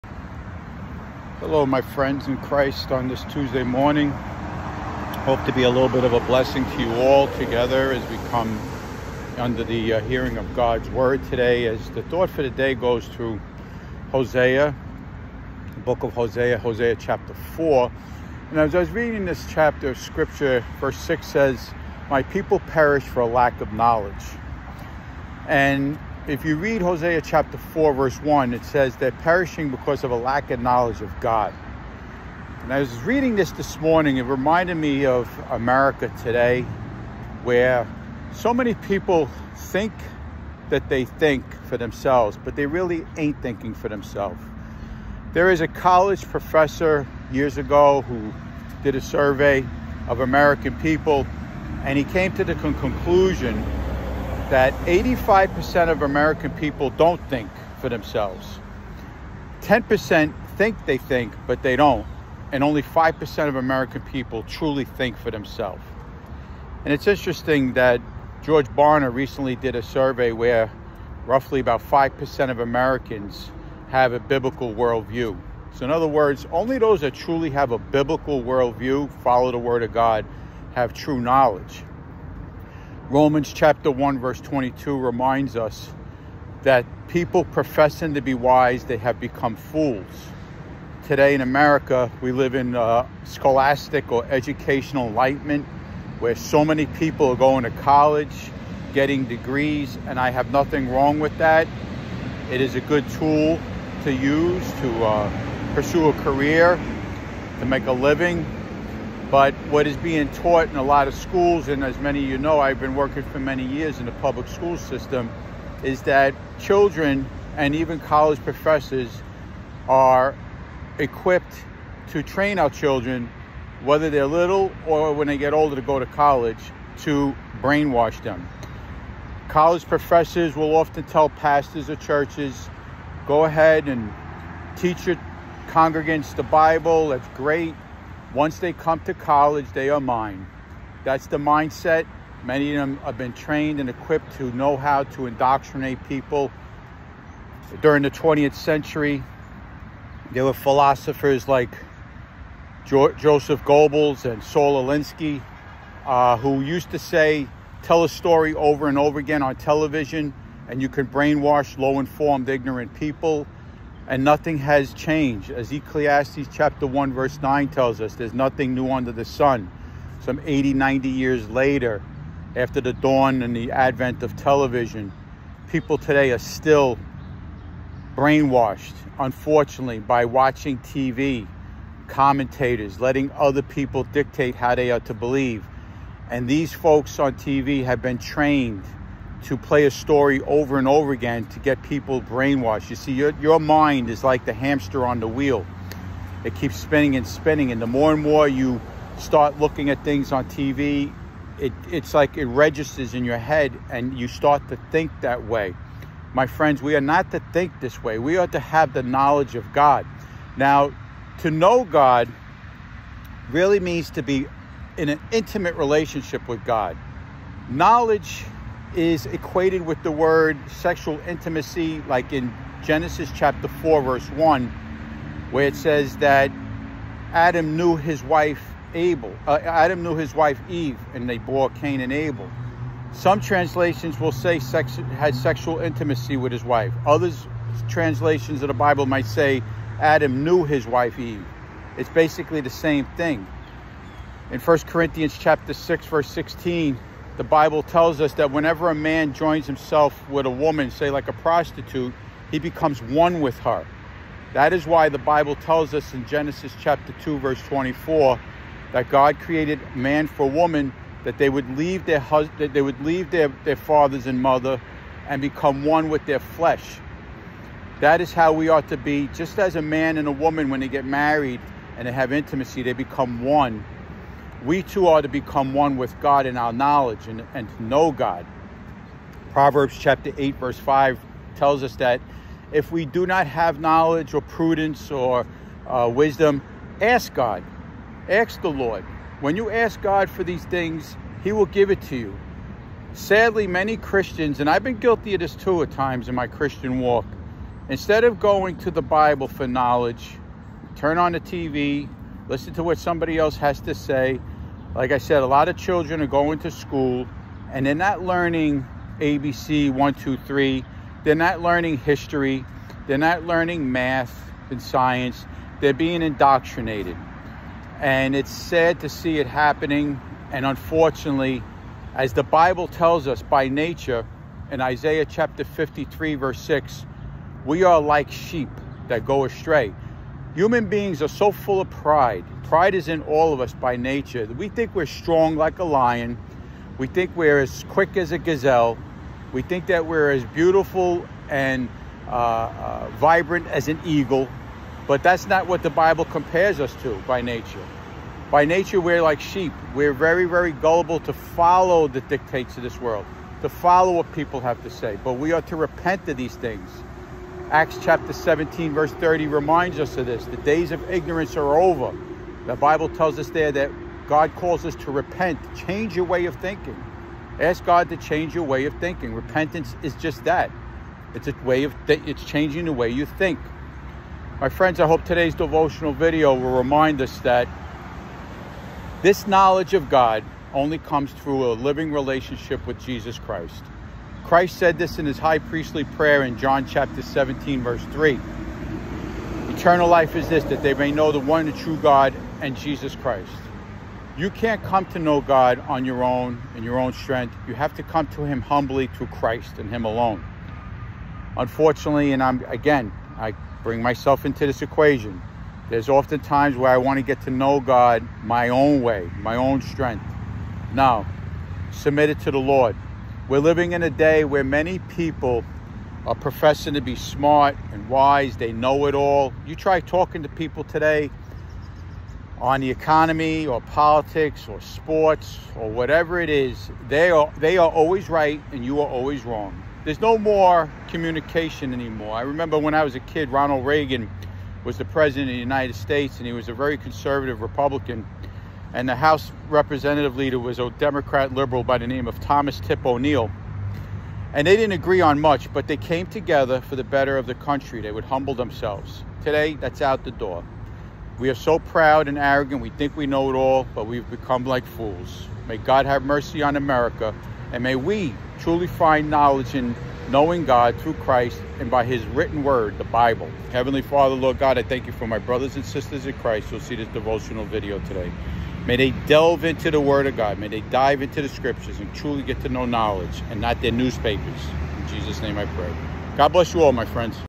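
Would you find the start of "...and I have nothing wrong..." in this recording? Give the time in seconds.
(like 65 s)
100 s.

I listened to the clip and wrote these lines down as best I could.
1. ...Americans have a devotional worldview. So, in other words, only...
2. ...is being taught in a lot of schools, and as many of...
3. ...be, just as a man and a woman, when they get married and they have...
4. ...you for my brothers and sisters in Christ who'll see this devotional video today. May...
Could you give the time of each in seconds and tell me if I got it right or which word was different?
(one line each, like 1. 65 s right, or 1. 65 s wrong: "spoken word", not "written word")
1. 72 s wrong: "biblical", not "devotional"
2. 109 s right
3. 268 s right
4. 465 s right.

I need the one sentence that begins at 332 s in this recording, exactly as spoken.
Pride is in all of us by nature.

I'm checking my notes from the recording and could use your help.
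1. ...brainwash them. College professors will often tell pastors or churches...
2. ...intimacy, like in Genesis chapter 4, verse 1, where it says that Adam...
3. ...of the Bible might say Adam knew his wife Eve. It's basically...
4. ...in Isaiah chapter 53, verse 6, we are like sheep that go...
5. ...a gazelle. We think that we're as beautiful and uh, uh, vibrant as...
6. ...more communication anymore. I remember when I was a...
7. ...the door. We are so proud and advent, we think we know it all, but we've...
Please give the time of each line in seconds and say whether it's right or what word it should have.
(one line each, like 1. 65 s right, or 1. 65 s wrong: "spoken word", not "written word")
1. 127 s right
2. 221 s right
3. 238 s right
4. 324 s right
5. 338 s right
6. 430 s right
7. 450 s wrong: "arrogant", not "advent".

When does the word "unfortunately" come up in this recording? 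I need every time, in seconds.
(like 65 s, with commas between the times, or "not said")
179 s, 320 s, 401 s.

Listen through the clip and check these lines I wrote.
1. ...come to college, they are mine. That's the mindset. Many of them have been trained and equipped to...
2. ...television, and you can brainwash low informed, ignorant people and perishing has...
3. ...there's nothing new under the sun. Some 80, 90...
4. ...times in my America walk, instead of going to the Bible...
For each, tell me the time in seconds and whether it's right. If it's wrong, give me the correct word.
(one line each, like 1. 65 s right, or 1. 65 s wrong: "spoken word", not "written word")
1. 138 s right
2. 159 s wrong: "nothing", not "perishing"
3. 168 s right
4. 295 s wrong: "Christian", not "America".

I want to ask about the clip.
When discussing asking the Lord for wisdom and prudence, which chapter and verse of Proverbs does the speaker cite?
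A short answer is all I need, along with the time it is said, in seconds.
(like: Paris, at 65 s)
Proverbs 8:5, at 279 s.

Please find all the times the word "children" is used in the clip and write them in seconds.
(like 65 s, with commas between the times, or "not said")
116 s, 122 s, 305 s.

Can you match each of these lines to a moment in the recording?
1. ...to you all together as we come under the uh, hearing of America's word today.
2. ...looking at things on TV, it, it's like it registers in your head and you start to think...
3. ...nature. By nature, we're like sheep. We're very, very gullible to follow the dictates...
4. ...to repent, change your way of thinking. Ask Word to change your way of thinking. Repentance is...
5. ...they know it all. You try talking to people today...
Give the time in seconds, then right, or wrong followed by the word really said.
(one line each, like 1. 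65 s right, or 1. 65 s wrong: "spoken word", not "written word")
1. 6 s wrong: "God", not "America"
2. 199 s right
3. 347 s right
4. 364 s wrong: "God", not "Word"
5. 418 s right.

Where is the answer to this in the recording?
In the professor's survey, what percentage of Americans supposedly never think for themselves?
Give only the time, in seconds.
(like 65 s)
54 s.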